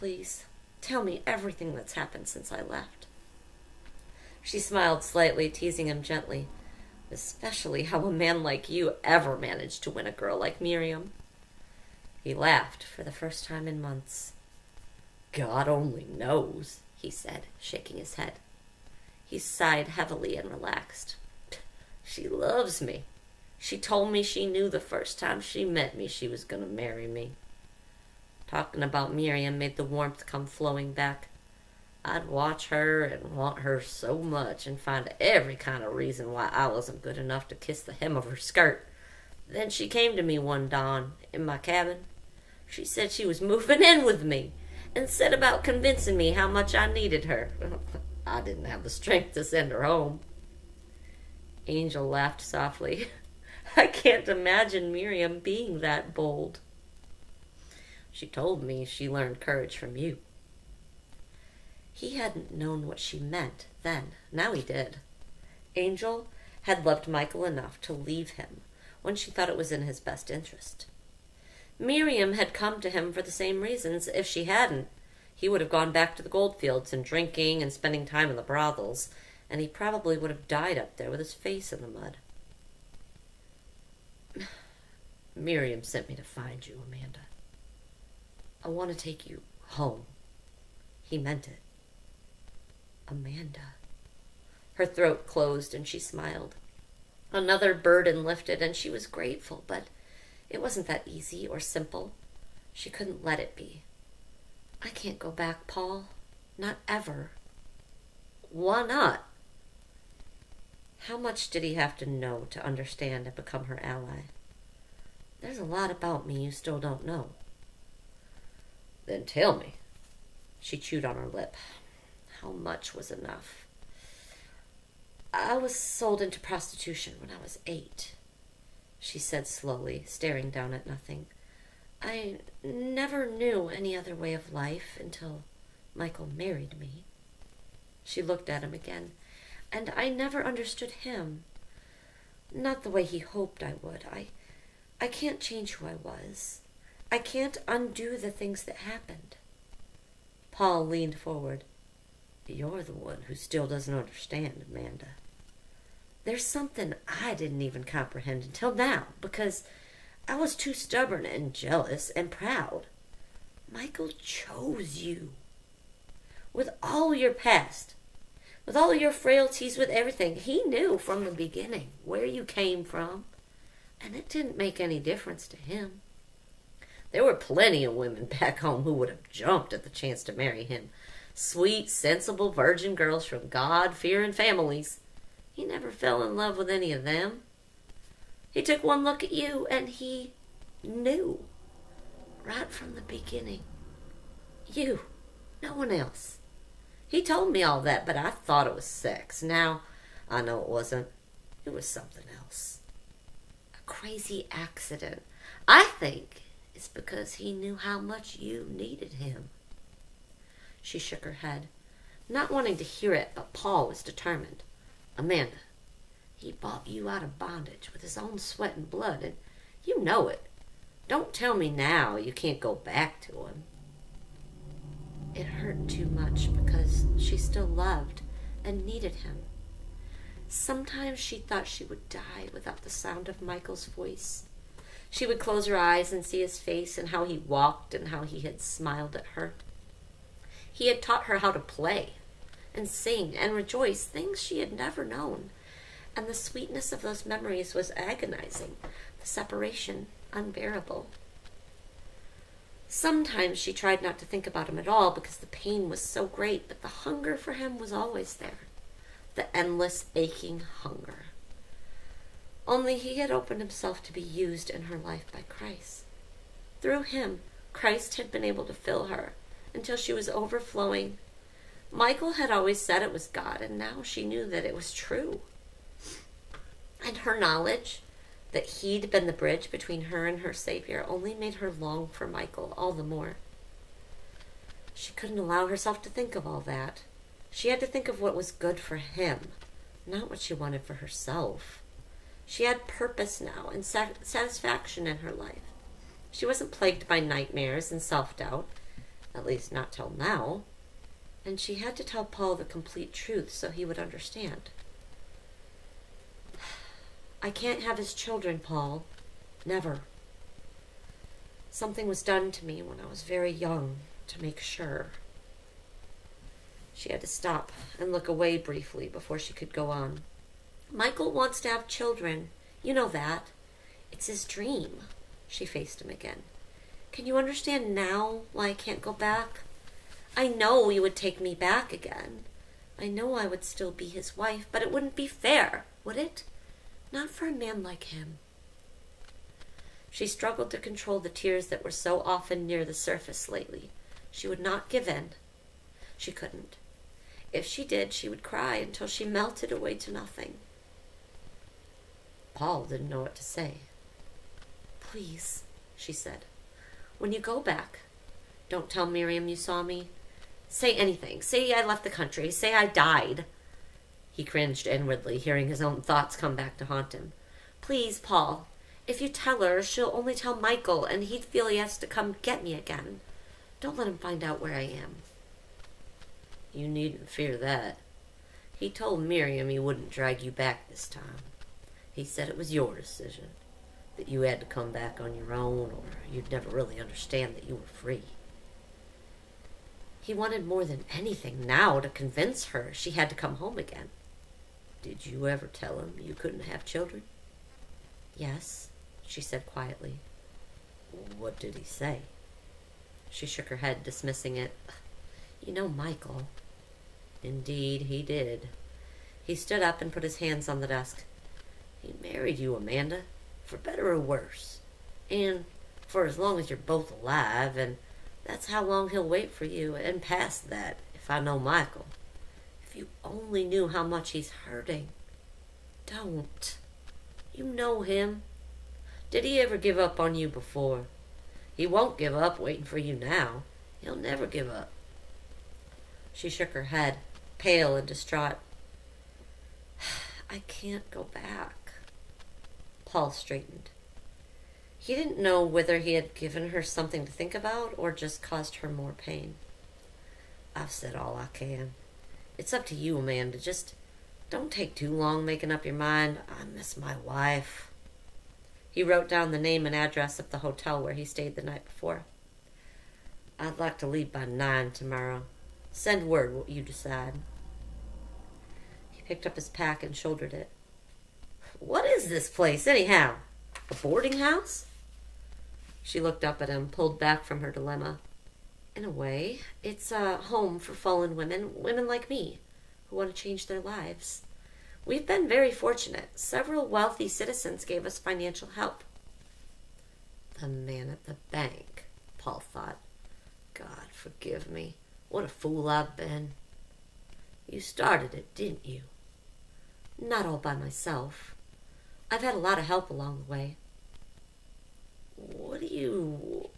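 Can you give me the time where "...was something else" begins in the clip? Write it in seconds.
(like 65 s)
201 s.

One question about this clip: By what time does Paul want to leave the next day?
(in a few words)
9.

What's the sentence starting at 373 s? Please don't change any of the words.
Don't let him find out where I am.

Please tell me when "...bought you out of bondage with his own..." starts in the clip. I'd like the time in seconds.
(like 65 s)
216 s.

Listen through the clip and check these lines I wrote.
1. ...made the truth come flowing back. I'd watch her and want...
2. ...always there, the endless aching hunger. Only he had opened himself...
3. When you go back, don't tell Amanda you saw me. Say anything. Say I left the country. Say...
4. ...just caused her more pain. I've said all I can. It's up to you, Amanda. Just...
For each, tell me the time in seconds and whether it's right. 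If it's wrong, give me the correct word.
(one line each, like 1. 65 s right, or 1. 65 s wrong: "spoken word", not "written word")
1. 29 s wrong: "warmth", not "truth"
2. 257 s right
3. 357 s wrong: "Miriam", not "Amanda"
4. 448 s right.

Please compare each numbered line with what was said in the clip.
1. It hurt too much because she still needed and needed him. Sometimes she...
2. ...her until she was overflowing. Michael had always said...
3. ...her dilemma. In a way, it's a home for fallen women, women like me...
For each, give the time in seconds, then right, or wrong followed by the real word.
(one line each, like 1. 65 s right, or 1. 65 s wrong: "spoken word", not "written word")
1. 225 s wrong: "loved", not "needed"
2. 269 s right
3. 477 s right.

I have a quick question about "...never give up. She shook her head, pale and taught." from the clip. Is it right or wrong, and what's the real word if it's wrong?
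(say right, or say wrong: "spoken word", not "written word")
wrong: "distraught", not "taught".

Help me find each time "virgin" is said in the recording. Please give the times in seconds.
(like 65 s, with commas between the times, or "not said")
182 s.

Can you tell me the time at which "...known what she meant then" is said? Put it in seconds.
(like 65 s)
62 s.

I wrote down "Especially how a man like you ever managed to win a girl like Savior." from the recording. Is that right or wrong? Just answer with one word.
wrong.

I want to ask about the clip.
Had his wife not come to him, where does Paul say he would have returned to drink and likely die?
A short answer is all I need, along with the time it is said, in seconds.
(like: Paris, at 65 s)
the goldfields, at 76 s.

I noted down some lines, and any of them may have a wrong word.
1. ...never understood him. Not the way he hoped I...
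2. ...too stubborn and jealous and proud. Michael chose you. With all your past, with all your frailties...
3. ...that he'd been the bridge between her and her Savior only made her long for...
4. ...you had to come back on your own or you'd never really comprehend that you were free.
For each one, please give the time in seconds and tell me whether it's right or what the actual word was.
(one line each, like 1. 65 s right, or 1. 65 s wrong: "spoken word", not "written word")
1. 140 s right
2. 160 s right
3. 278 s right
4. 384 s wrong: "understand", not "comprehend".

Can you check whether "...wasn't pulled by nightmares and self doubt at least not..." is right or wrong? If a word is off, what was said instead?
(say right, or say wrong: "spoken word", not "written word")
wrong: "plagued", not "pulled".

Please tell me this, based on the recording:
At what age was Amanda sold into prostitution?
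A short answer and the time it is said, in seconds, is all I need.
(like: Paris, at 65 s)
8, at 127 s.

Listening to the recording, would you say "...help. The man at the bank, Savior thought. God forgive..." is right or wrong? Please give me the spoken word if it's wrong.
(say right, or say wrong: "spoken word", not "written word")
wrong: "Paul", not "Savior".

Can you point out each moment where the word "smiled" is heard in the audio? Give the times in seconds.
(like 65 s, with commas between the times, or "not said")
4 s, 95 s, 238 s.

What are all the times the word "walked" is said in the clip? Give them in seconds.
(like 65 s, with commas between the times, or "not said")
237 s.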